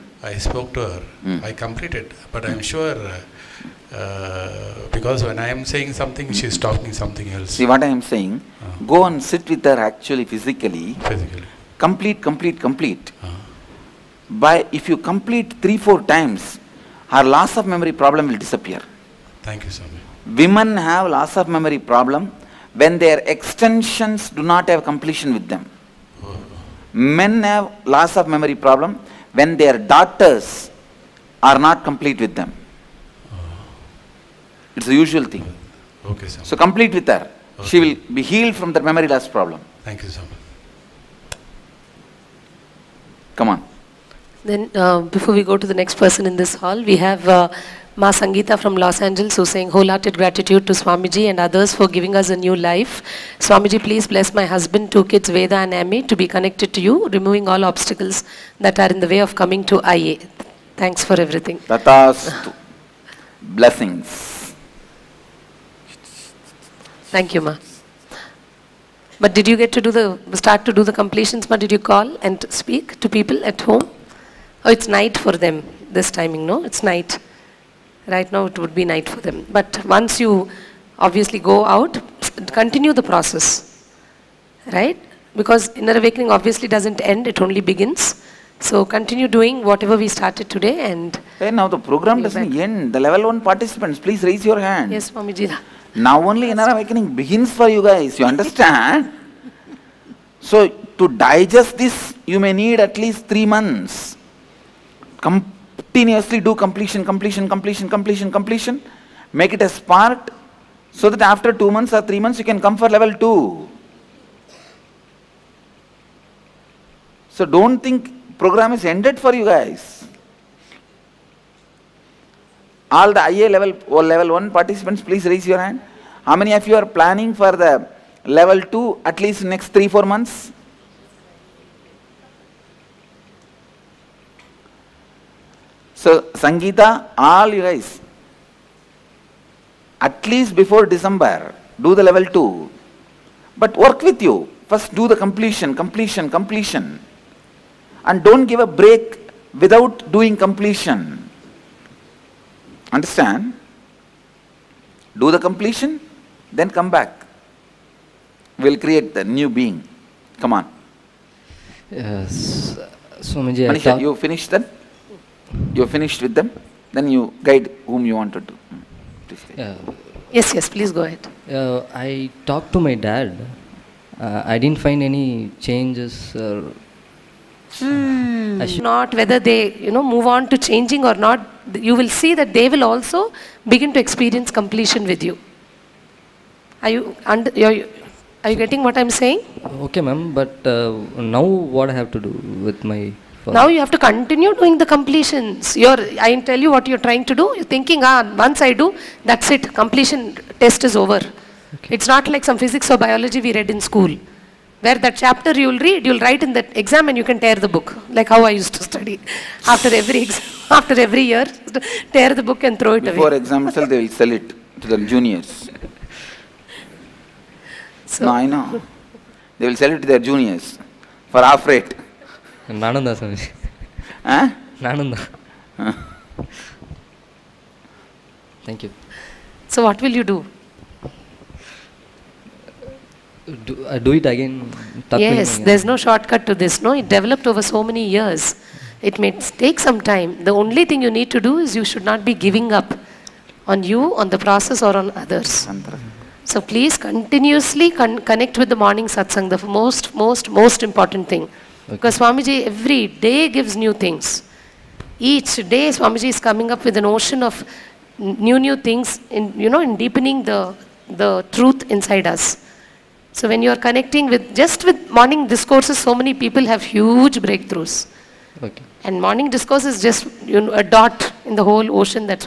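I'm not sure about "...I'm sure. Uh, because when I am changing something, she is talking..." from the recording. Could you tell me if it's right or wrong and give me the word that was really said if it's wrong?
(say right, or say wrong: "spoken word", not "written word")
wrong: "saying", not "changing".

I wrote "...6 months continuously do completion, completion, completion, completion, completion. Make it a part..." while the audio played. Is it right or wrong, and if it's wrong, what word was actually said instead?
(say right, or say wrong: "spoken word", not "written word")
wrong: "3", not "6".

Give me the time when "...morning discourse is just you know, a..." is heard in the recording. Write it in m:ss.
4:29.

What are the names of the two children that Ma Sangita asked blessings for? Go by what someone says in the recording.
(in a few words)
Veda and Amy.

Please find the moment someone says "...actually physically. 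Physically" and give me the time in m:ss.
0:09.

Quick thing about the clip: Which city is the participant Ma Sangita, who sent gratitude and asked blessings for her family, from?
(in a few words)
Los Angeles.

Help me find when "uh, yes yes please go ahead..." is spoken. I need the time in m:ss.
2:49.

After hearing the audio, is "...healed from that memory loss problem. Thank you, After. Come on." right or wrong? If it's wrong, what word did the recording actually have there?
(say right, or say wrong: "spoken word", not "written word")
wrong: "Swami", not "After".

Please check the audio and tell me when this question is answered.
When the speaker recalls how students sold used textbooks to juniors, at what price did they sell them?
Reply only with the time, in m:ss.
3:41.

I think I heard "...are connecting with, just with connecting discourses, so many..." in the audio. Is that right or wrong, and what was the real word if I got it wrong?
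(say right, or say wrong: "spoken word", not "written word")
wrong: "morning", not "connecting".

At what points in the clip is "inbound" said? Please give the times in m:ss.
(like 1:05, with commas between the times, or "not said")
not said.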